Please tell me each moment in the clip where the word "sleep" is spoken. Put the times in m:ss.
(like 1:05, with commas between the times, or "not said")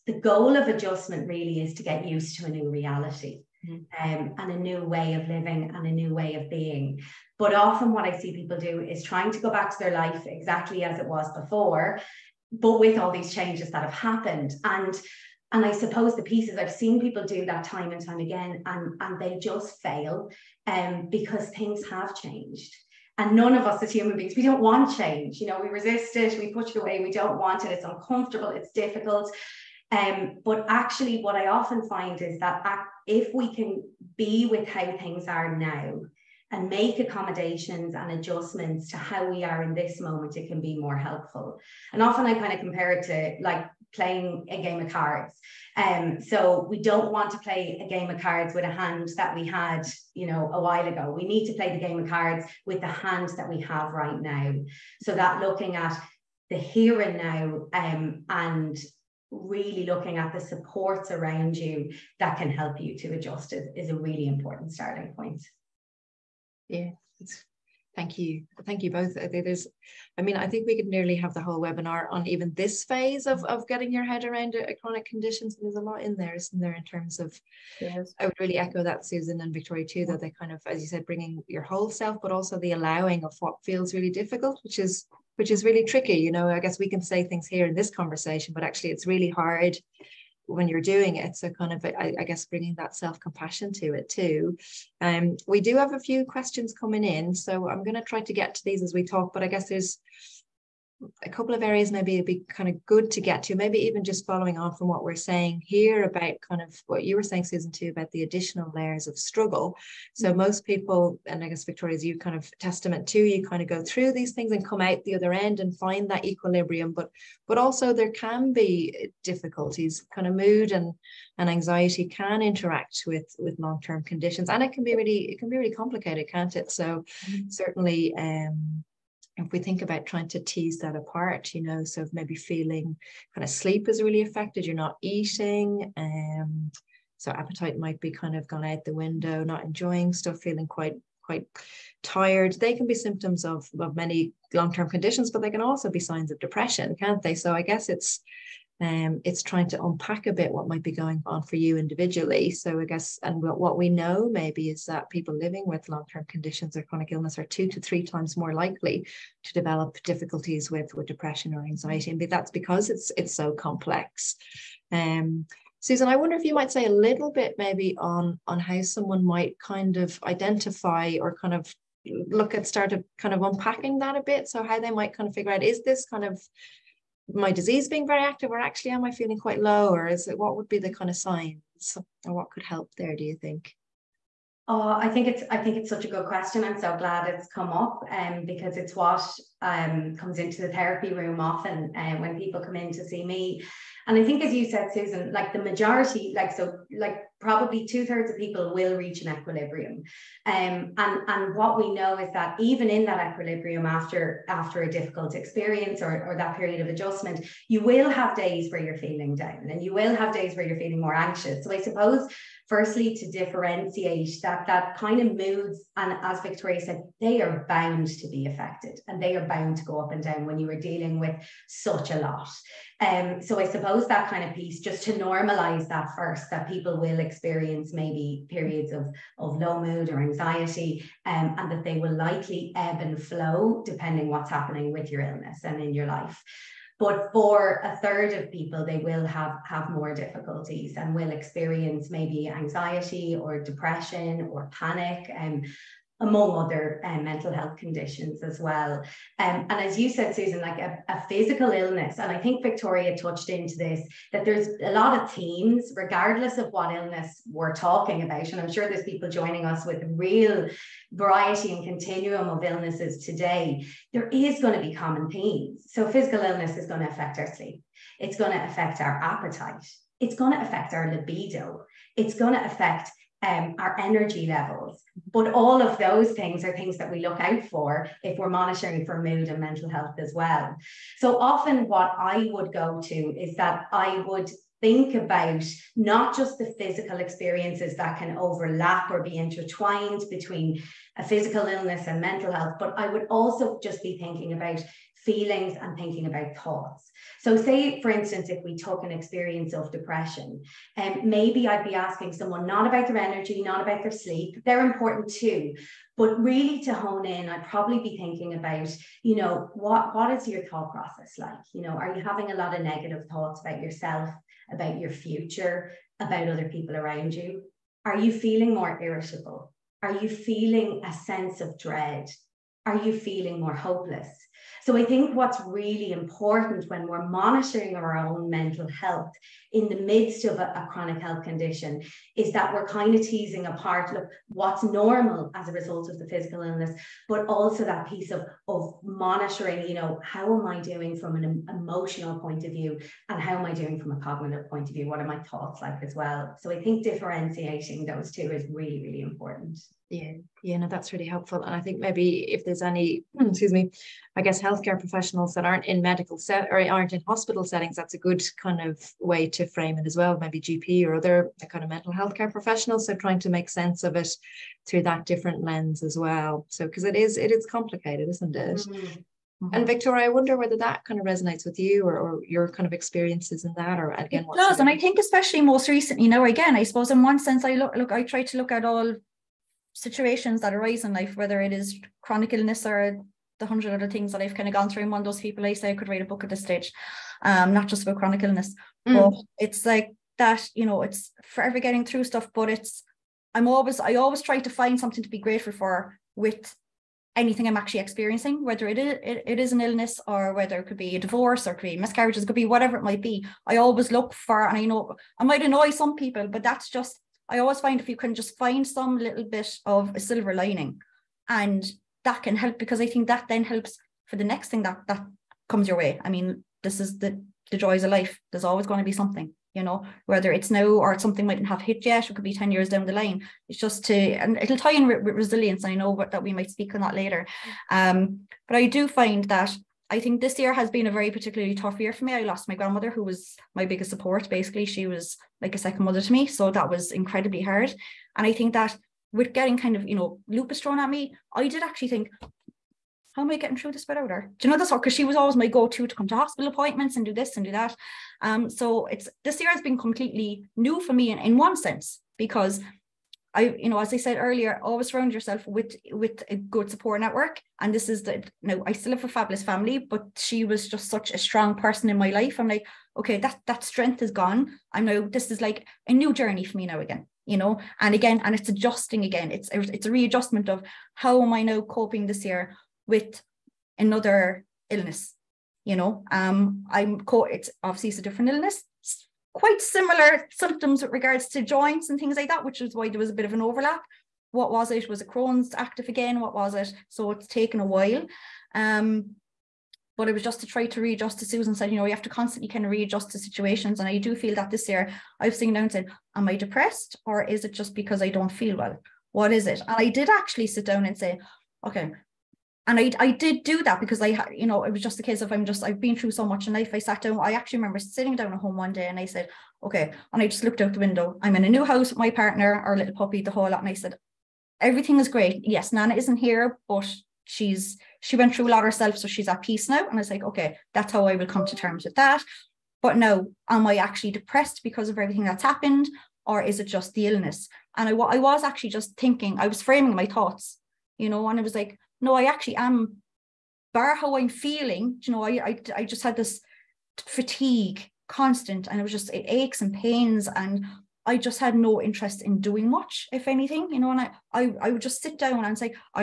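2:13, 4:27, 5:04.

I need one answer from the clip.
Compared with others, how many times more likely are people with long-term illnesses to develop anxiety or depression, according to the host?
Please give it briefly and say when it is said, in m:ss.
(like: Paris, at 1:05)
2 to 3 times, at 2:37.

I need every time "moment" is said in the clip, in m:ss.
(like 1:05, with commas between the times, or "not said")
0:39.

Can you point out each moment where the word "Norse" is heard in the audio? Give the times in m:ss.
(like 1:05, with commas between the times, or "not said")
not said.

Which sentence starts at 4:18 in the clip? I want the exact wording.
And I'm sure there's people joining us with real variety and continuum of illnesses today.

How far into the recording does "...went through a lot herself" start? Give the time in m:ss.
8:38.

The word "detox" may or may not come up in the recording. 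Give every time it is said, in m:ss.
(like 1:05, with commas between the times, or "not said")
not said.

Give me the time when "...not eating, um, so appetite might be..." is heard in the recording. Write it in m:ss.
2:14.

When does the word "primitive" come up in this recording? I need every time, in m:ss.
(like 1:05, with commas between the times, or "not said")
not said.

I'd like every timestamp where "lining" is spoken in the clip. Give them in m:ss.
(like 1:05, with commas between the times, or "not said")
6:50.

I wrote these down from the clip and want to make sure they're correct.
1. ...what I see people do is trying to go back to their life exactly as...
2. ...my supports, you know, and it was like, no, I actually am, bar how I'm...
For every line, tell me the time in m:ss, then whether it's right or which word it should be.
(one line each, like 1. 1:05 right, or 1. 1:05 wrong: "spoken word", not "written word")
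1. 0:07 right
2. 8:50 wrong: "thoughts", not "supports".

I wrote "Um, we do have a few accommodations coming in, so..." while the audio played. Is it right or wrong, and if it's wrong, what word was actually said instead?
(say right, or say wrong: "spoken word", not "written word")
wrong: "questions", not "accommodations".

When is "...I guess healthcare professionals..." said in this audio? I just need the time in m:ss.
5:54.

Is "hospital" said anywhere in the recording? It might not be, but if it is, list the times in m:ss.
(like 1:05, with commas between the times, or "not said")
5:57, 7:26.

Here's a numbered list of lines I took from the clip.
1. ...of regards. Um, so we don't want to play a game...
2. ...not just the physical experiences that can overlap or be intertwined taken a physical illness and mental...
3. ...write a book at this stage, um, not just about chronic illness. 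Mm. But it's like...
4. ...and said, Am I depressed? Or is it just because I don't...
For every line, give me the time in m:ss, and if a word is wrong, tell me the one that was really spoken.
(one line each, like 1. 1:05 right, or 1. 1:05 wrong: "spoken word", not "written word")
1. 0:44 wrong: "cards", not "regards"
2. 4:45 wrong: "between", not "taken"
3. 6:26 right
4. 8:15 right.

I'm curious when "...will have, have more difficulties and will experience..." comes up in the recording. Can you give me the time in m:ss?
3:58.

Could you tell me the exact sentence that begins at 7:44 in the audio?
I'm now this is like a new journey for me now again, you know.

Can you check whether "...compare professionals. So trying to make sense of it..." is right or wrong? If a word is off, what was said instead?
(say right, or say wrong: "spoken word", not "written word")
wrong: "healthcare", not "compare".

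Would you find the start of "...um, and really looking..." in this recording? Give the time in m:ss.
0:57.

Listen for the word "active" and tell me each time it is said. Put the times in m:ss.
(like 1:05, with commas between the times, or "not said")
2:58, 8:05.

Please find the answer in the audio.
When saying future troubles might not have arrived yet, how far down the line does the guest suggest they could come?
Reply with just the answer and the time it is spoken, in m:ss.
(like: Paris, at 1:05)
10 years, at 7:02.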